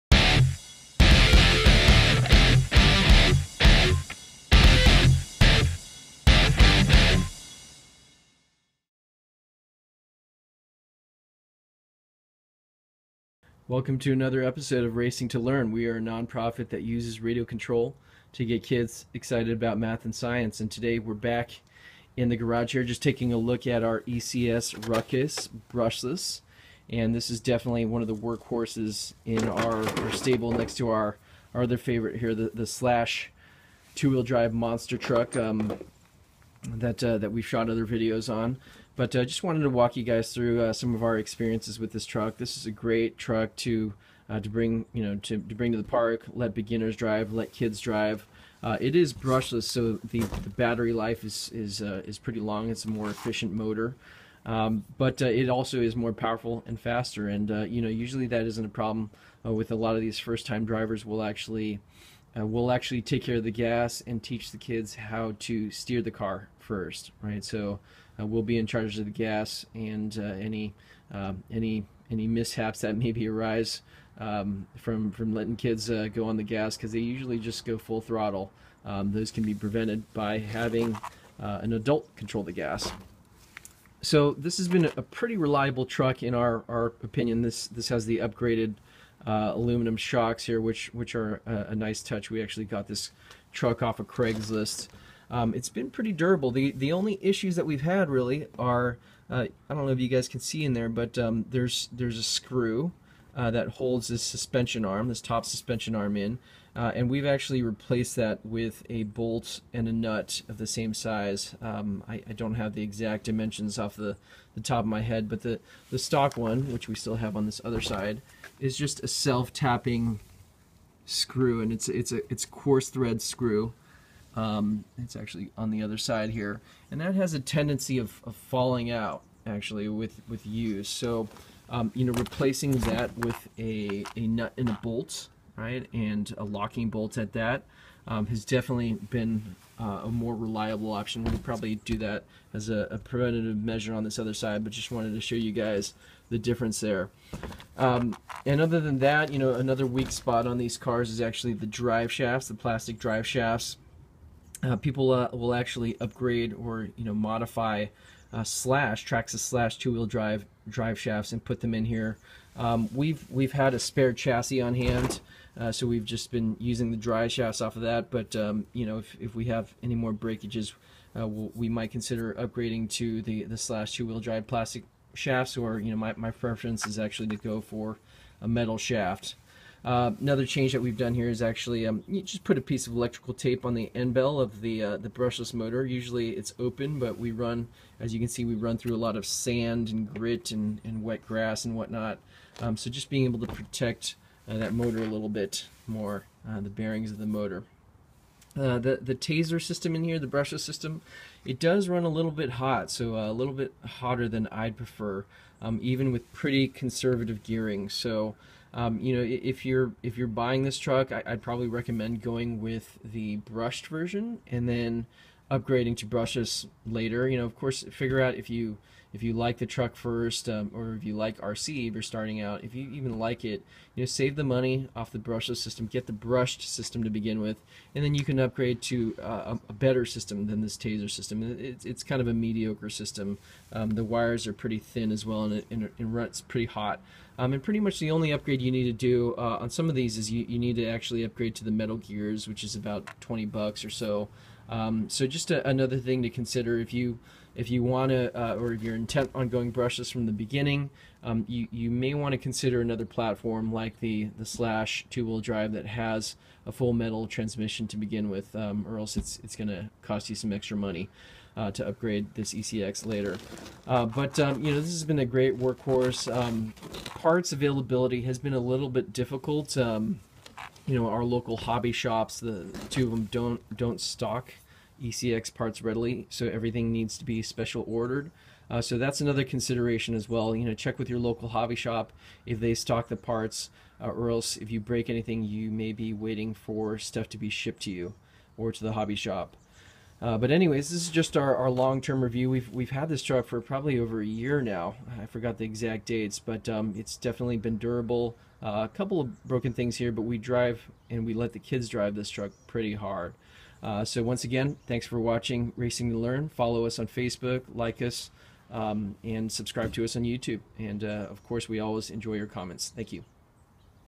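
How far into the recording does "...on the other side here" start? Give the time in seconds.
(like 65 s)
125 s.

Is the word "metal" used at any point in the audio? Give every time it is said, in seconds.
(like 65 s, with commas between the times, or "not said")
178 s, 241 s, 256 s.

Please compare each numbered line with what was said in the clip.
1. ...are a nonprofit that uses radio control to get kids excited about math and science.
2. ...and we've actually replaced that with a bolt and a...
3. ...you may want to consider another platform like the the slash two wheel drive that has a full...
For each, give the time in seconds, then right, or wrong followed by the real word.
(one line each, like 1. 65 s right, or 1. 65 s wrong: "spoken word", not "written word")
1. 15 s right
2. 106 s right
3. 251 s right.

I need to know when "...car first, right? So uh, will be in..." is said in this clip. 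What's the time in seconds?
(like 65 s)
66 s.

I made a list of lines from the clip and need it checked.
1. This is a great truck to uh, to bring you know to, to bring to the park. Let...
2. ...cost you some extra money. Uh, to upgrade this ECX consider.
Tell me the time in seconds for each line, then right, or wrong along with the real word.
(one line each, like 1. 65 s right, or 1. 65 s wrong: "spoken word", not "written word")
1. 42 s right
2. 260 s wrong: "later", not "consider".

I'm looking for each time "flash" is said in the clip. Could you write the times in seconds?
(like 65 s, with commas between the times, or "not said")
not said.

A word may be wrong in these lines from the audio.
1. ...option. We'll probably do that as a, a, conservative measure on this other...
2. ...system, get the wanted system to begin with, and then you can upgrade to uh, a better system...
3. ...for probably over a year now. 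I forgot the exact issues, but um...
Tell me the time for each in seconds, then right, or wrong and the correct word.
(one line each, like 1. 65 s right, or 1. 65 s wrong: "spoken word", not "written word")
1. 140 s wrong: "preventative", not "conservative"
2. 225 s wrong: "brushed", not "wanted"
3. 293 s wrong: "dates", not "issues".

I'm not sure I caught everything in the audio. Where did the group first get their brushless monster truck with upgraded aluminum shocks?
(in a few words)
Craigslist.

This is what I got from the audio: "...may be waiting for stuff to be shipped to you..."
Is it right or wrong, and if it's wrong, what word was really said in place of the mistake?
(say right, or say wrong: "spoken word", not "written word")
right.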